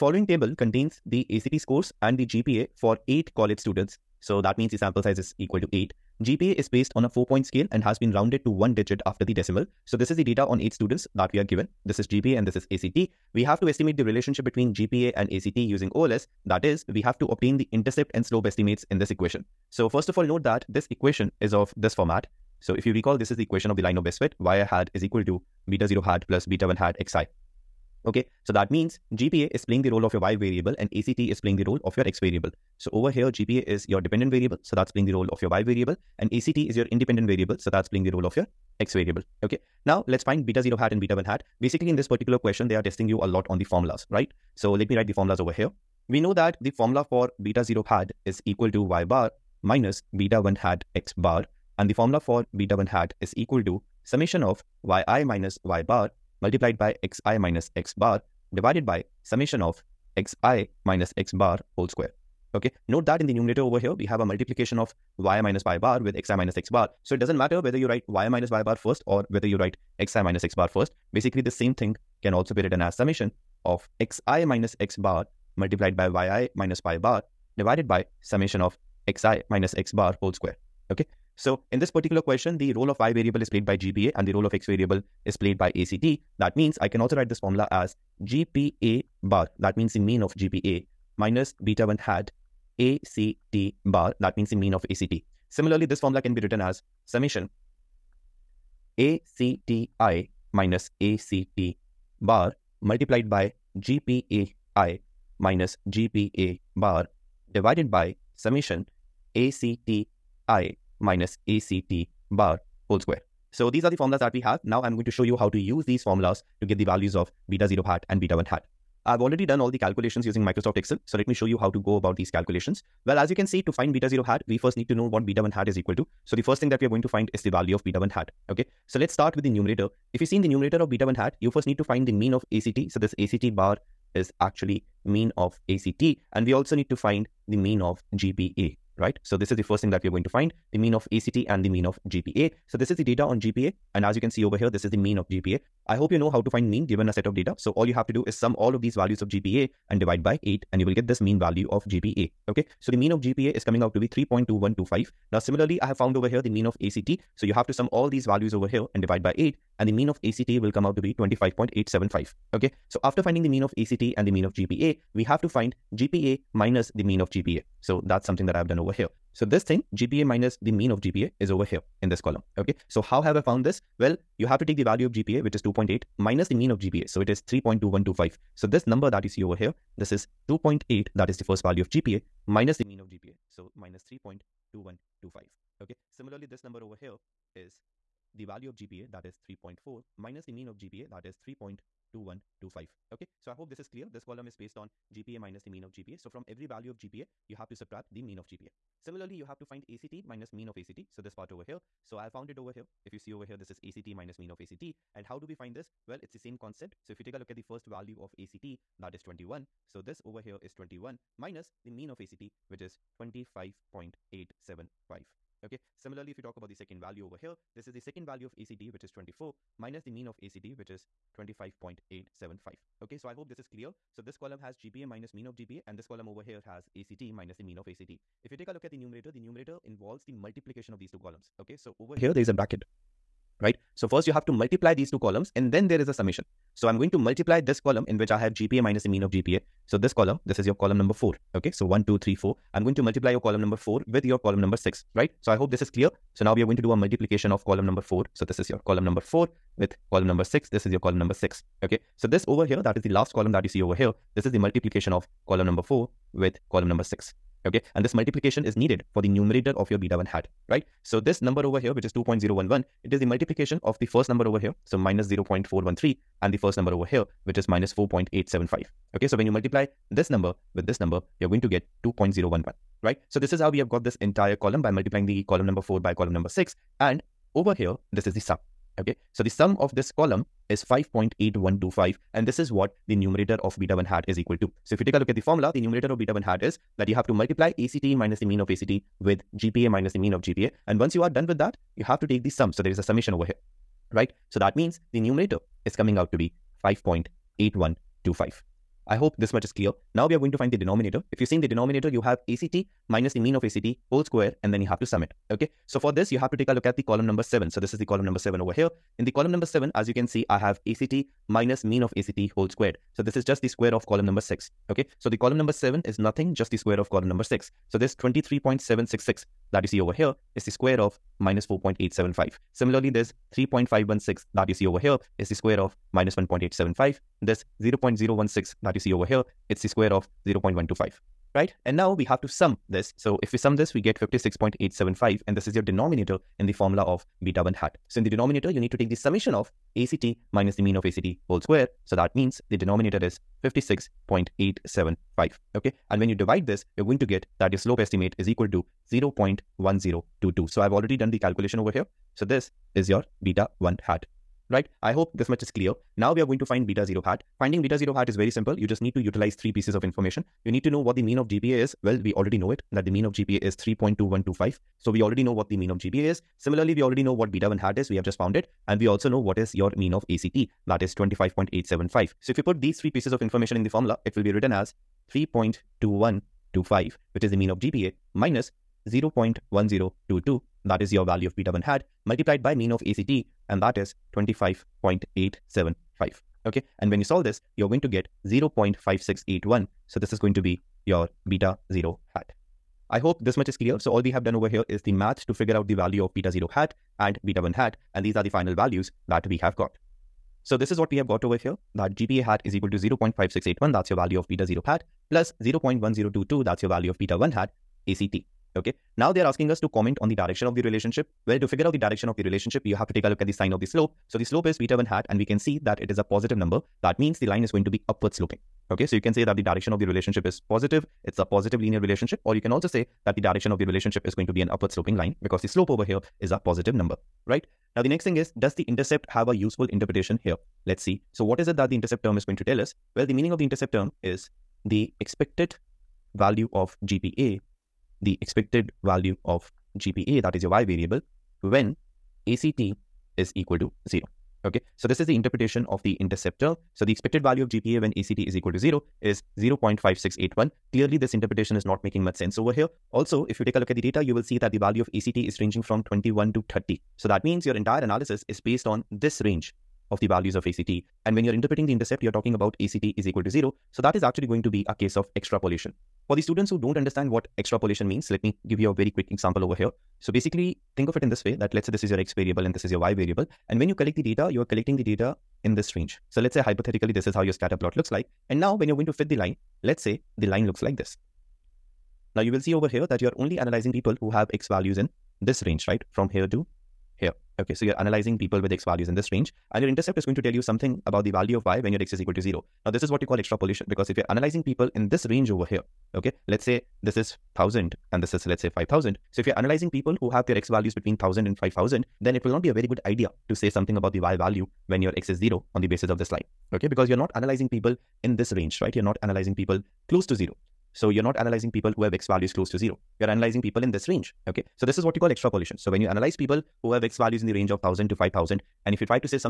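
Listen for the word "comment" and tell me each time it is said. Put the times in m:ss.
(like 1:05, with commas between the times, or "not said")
6:49.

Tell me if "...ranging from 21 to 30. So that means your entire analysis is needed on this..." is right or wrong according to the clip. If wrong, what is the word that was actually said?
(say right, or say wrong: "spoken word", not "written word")
wrong: "based", not "needed".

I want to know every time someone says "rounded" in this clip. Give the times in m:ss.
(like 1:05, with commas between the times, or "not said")
0:08.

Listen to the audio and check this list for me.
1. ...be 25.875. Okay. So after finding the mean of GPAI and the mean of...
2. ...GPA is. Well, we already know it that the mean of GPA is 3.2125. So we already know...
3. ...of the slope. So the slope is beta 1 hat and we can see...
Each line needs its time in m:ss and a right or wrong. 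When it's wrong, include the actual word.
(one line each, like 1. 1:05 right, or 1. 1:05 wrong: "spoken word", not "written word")
1. 2:41 wrong: "ACT", not "GPAI"
2. 6:01 right
3. 6:53 right.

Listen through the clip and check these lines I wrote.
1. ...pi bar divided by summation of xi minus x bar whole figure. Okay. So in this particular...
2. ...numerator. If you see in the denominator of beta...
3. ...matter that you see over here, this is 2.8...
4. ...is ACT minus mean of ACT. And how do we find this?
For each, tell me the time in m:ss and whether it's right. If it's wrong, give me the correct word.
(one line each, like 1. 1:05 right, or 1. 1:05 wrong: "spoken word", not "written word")
1. 1:16 wrong: "square", not "figure"
2. 2:09 wrong: "numerator", not "denominator"
3. 2:58 wrong: "number", not "matter"
4. 3:23 right.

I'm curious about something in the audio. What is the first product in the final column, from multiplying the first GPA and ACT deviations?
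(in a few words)
2.011.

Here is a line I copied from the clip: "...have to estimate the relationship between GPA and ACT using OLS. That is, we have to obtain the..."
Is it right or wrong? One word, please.
right.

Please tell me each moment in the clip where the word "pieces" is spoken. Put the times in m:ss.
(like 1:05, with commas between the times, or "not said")
5:59, 6:13.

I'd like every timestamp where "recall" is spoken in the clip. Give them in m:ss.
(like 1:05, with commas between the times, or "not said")
0:22.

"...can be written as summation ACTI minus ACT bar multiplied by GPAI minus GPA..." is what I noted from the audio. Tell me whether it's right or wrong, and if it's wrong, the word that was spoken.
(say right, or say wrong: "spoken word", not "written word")
right.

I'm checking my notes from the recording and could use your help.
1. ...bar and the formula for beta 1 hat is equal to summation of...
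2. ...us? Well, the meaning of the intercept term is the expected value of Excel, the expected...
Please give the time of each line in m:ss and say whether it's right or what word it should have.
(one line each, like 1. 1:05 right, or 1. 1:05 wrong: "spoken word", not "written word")
1. 0:51 right
2. 7:12 wrong: "GPA", not "Excel".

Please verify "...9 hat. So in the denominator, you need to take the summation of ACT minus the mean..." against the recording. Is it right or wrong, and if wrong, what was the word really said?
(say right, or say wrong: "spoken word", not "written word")
wrong: "1", not "9".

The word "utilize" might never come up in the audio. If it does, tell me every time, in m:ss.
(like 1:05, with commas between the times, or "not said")
5:59.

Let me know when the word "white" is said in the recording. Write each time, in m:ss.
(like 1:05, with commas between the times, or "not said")
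not said.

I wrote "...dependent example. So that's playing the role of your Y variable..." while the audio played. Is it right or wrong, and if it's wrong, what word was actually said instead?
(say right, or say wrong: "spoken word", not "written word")
wrong: "variable", not "example".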